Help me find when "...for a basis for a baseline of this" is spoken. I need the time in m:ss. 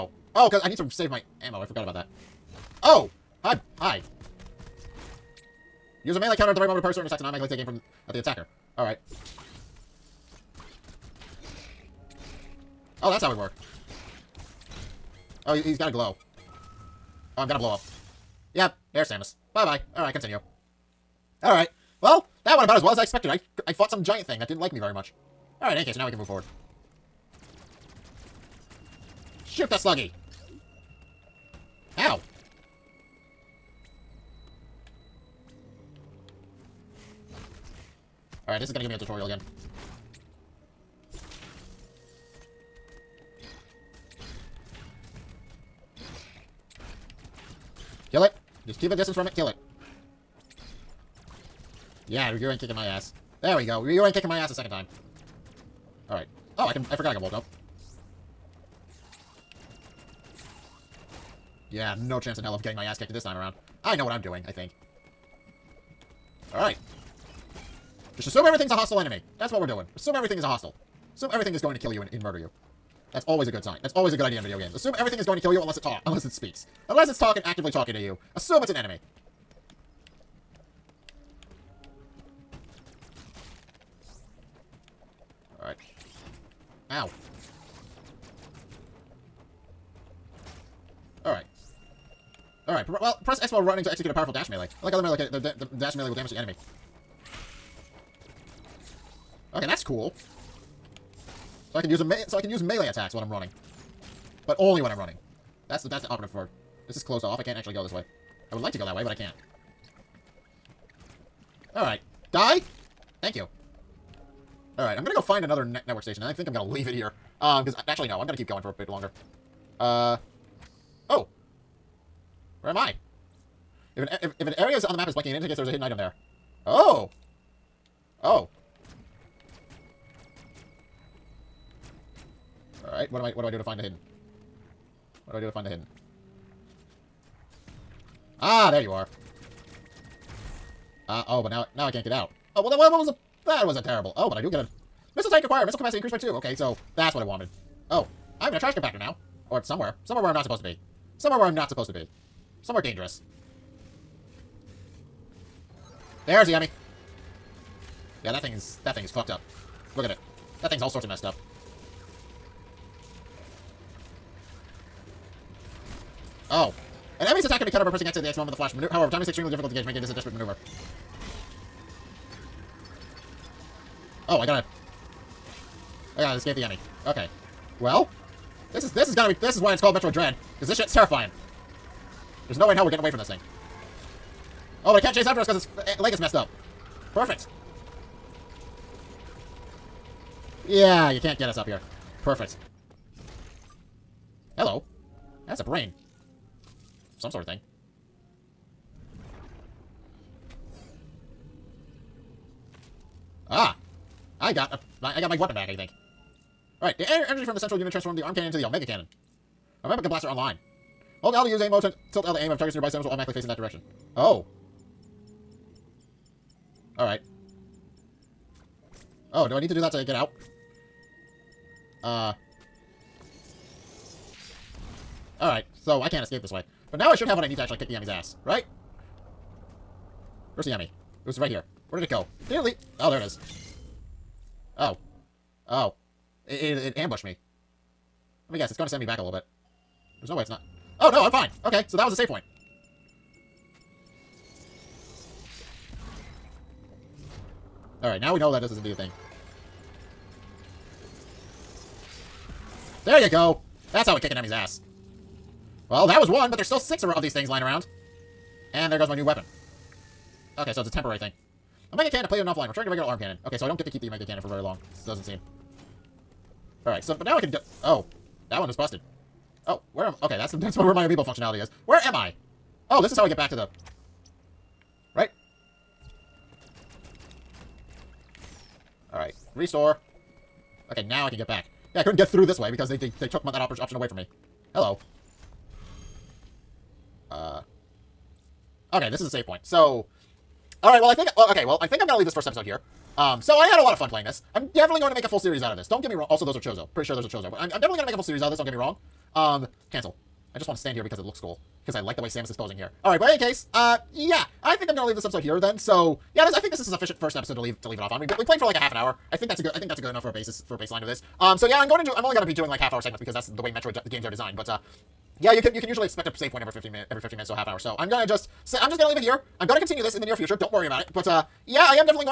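5:10.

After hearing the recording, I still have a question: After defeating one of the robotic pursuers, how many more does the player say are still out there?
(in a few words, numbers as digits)
6.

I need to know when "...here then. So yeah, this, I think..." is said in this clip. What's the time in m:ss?
5:05.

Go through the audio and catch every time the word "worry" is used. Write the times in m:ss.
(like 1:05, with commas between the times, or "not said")
5:20.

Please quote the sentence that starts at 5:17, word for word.
So I'm gonna just say I'm just gonna leave it here.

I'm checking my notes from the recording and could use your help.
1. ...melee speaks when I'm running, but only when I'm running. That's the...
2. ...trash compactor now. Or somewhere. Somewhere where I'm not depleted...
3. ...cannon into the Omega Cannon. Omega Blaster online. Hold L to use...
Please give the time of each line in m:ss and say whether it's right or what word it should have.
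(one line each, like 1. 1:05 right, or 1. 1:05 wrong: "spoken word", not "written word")
1. 1:42 wrong: "attacks", not "speaks"
2. 2:28 wrong: "supposed", not "depleted"
3. 3:28 right.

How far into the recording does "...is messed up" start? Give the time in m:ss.
3:06.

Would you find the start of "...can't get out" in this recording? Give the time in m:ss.
2:21.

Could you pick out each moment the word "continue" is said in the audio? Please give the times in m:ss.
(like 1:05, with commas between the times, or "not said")
0:20, 5:19.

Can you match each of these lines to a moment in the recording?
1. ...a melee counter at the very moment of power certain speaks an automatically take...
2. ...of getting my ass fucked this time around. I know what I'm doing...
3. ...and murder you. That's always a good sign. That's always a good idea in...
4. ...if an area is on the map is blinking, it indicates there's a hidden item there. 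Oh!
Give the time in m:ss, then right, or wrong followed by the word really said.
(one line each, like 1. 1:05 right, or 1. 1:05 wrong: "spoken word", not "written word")
1. 0:06 wrong: "attacks", not "speaks"
2. 1:02 wrong: "kicked", not "fucked"
3. 1:12 right
4. 2:04 right.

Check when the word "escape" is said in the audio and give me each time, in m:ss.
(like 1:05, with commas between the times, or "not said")
2:56, 3:46.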